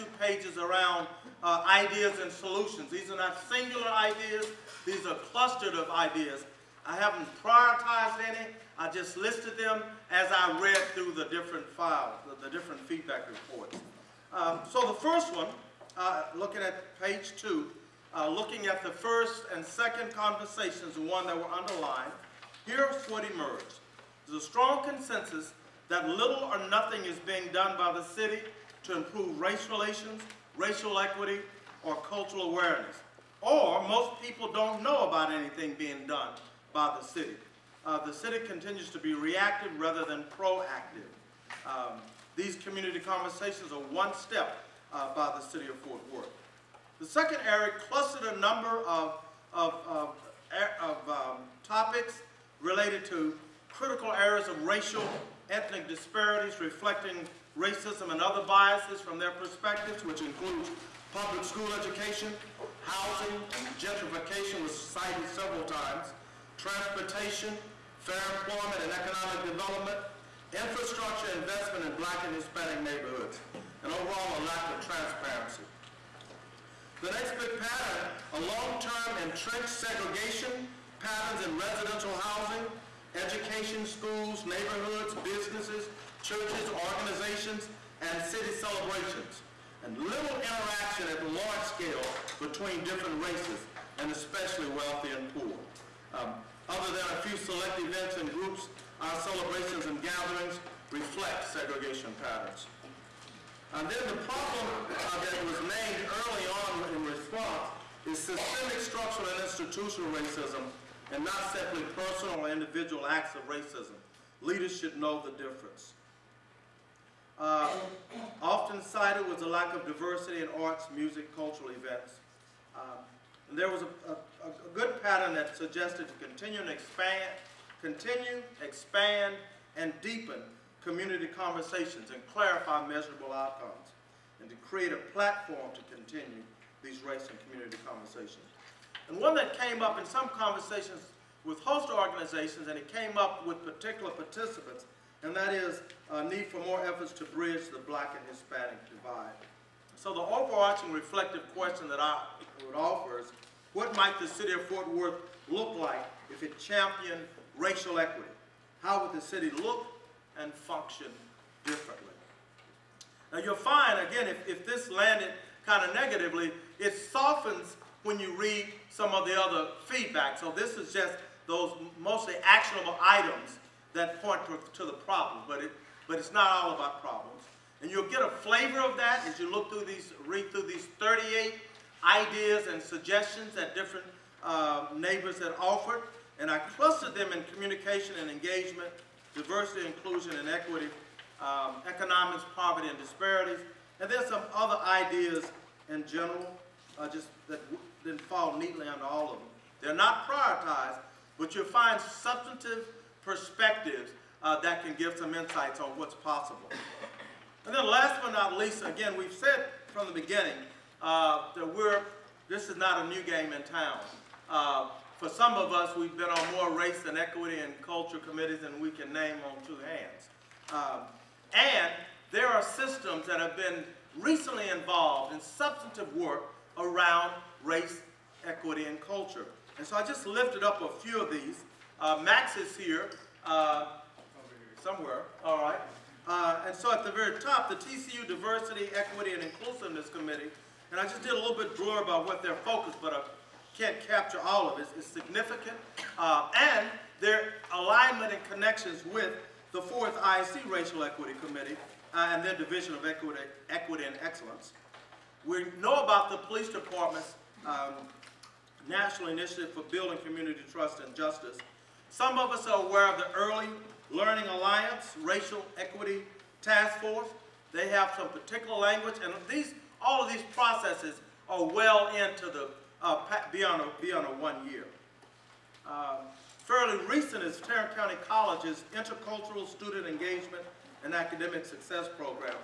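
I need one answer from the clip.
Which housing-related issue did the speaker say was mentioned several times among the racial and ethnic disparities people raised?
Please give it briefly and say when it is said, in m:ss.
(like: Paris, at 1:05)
Gentrification, at 1:03.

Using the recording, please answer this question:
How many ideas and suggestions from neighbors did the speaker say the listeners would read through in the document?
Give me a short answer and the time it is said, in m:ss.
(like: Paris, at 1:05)
38, at 3:00.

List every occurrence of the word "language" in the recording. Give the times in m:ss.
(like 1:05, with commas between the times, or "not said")
4:28.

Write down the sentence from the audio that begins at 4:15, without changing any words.
We know about the police department's um, National Initiative for Building Community Trust and Justice.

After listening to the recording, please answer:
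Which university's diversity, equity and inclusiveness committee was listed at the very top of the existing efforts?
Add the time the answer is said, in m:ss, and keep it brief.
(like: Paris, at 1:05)
TCU, at 3:57.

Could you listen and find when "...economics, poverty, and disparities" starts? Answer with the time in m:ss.
3:11.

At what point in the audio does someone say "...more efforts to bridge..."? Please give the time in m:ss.
2:26.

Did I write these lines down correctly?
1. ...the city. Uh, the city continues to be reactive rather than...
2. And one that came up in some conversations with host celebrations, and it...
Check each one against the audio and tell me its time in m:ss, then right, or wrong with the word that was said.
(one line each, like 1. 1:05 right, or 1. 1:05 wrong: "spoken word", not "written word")
1. 0:36 right
2. 2:19 wrong: "organizations", not "celebrations".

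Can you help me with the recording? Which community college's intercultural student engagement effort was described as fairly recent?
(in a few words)
Tarrant County College.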